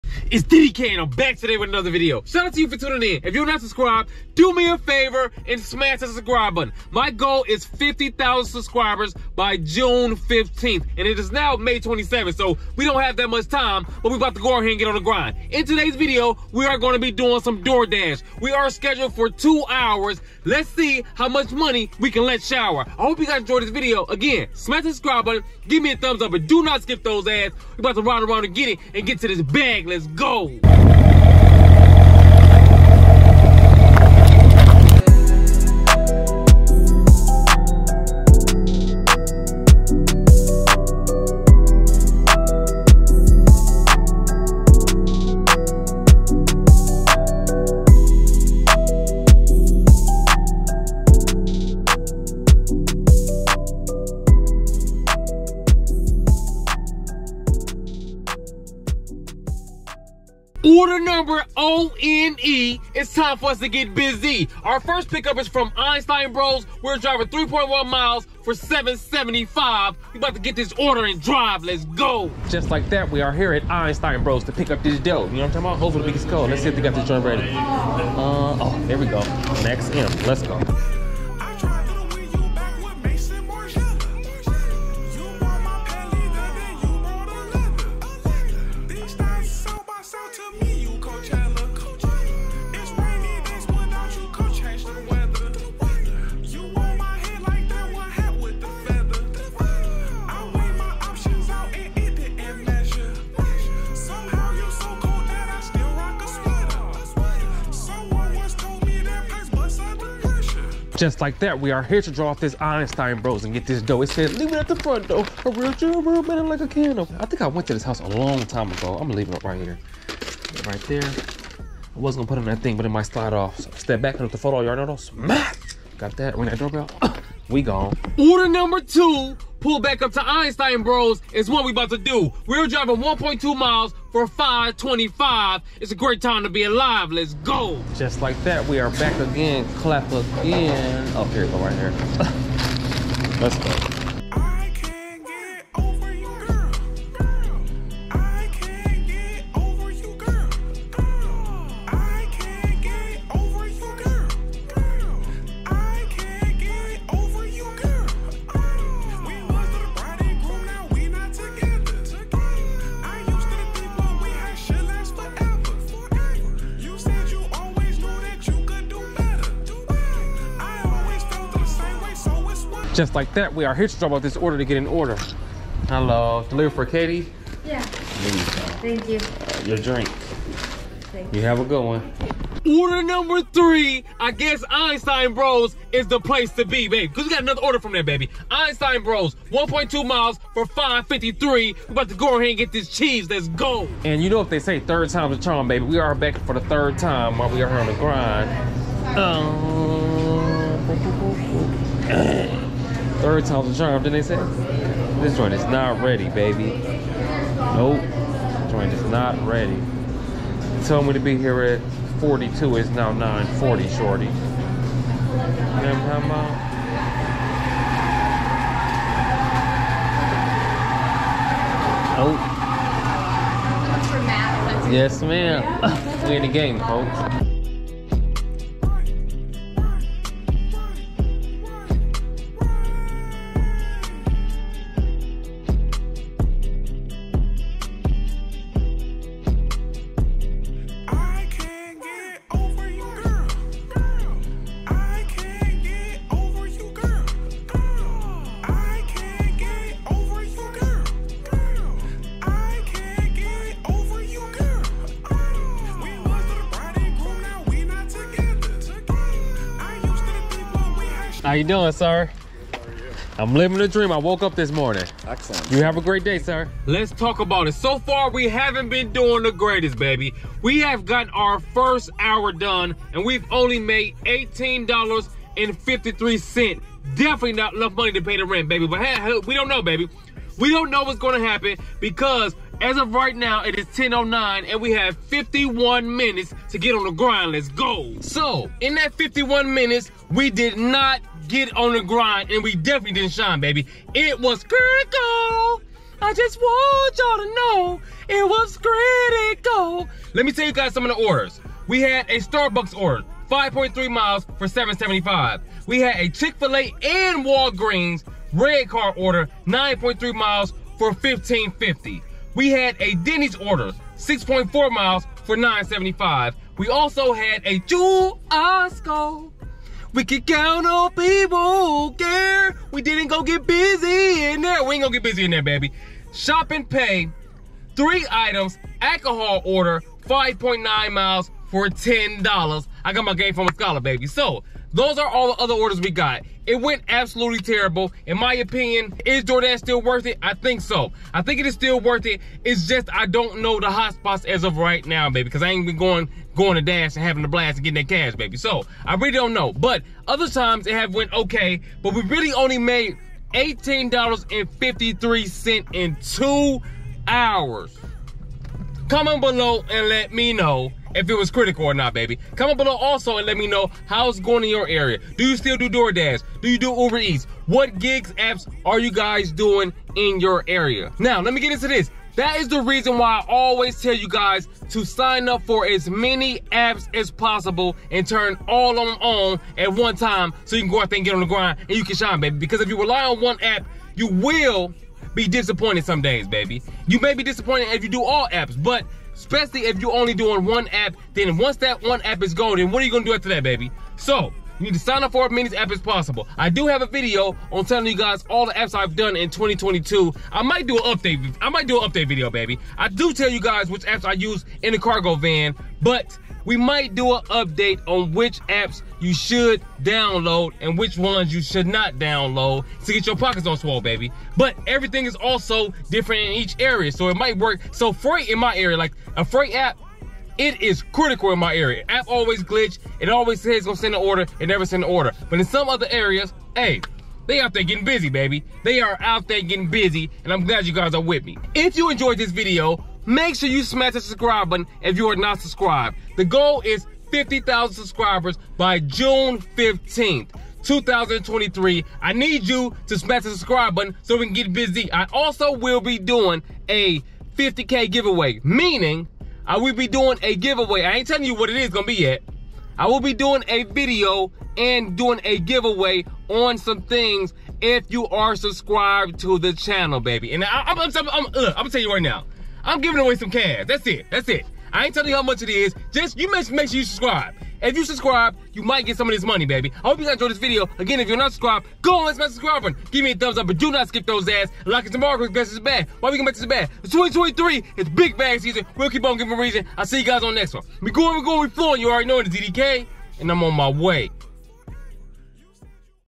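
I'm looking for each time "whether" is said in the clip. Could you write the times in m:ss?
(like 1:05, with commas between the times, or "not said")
not said.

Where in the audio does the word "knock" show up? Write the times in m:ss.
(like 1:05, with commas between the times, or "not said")
not said.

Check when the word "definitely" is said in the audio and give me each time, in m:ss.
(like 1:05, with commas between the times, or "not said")
4:37, 4:52.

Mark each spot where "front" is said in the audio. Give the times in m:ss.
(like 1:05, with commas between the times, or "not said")
1:54.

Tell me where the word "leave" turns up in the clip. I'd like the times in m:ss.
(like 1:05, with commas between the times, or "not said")
1:54, 1:59.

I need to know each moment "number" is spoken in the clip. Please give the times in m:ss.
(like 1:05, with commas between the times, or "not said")
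1:00, 2:08, 3:03.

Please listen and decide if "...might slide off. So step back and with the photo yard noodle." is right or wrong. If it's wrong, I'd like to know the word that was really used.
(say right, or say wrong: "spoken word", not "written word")
right.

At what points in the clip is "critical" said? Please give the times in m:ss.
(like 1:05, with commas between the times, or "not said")
4:54, 4:58, 6:01, 7:01.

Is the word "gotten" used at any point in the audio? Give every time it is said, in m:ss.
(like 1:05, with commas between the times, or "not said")
4:31.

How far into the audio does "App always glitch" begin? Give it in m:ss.
7:02.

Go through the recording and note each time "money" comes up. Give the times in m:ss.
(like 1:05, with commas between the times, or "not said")
0:21, 4:37, 7:49.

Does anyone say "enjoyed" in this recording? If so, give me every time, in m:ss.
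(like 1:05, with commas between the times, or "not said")
0:23, 7:12, 7:50.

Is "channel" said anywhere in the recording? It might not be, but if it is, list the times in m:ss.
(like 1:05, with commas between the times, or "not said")
7:39.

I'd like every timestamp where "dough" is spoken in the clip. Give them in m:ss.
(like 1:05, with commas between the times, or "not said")
1:14, 1:53.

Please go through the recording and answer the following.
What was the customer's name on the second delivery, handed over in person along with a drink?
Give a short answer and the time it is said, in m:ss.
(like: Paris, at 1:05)
Katie, at 2:56.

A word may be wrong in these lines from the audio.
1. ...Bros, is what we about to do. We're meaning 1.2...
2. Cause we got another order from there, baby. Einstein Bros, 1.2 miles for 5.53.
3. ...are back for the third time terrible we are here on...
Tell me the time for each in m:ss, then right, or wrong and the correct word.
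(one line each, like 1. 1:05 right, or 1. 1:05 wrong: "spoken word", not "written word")
1. 2:10 wrong: "driving", not "meaning"
2. 3:07 right
3. 3:15 wrong: "while", not "terrible".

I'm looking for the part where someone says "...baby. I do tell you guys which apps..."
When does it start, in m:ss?
6:42.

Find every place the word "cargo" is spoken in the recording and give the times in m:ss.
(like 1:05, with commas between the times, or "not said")
6:44.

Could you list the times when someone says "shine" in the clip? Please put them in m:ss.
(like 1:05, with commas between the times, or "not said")
4:53, 6:22.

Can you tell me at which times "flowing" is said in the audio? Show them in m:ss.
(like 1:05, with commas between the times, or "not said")
8:01.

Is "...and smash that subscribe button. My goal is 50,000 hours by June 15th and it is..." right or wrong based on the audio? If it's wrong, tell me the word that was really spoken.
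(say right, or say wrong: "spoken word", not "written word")
wrong: "subscribers", not "hours".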